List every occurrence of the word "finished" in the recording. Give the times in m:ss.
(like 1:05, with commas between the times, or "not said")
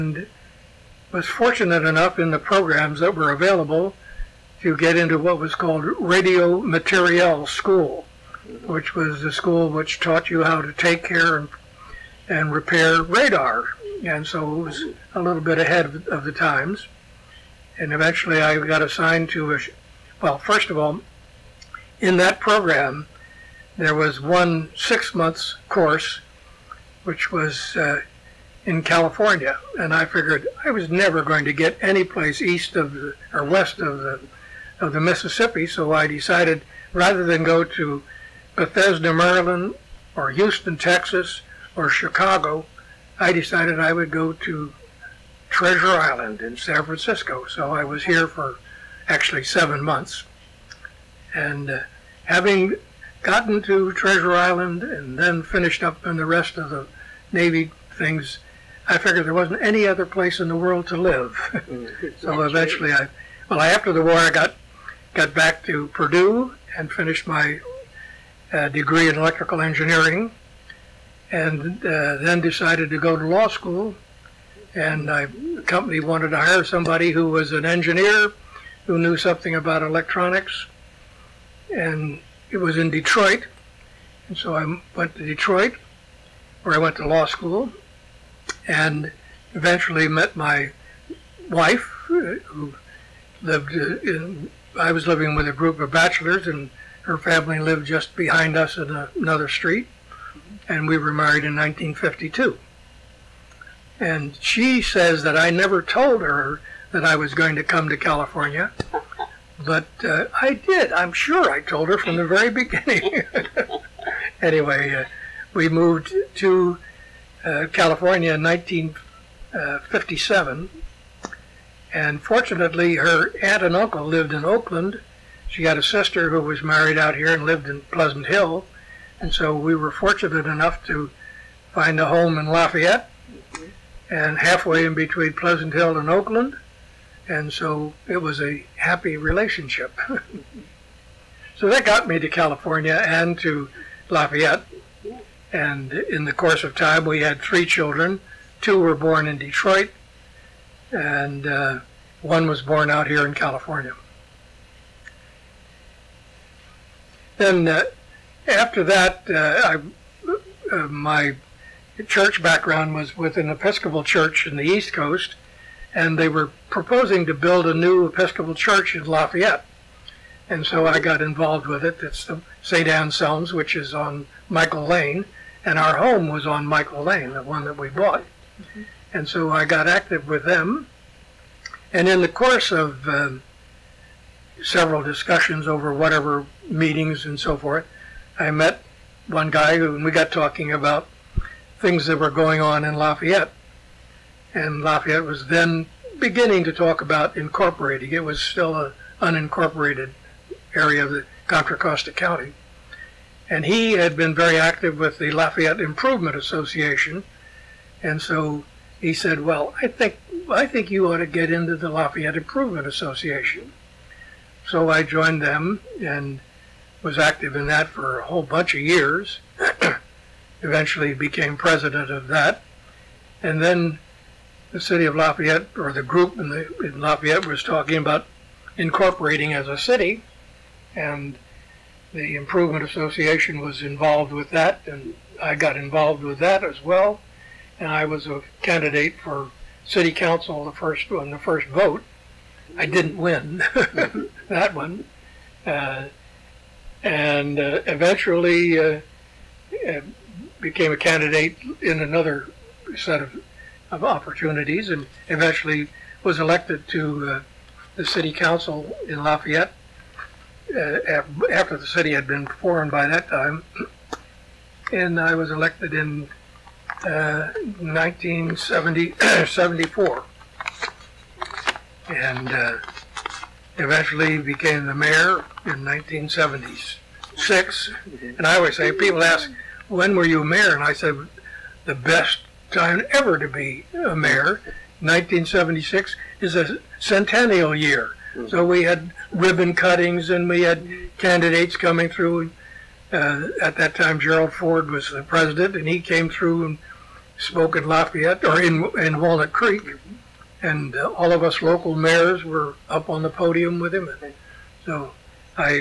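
0:55, 1:06.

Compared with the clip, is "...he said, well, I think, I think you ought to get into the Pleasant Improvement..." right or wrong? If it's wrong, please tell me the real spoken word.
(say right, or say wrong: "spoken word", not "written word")
wrong: "Lafayette", not "Pleasant".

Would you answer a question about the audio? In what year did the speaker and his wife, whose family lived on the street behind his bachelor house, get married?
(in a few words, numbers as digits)
1952.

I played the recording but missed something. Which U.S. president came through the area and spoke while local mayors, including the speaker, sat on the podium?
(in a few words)
Gerald Ford.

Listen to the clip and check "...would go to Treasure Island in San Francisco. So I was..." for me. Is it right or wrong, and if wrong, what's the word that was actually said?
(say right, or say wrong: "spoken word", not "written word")
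right.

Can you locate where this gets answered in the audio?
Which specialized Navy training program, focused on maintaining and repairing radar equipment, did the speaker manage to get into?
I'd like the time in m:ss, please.
0:05.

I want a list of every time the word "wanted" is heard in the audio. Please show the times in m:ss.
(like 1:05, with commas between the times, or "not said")
1:16.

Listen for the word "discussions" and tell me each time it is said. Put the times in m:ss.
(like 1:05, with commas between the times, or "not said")
3:05.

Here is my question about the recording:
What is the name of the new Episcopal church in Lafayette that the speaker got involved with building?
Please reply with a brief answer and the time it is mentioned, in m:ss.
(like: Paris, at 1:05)
St. Anselm's, at 2:52.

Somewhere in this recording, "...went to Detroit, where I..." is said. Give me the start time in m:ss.
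1:24.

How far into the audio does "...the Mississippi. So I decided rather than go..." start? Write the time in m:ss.
0:34.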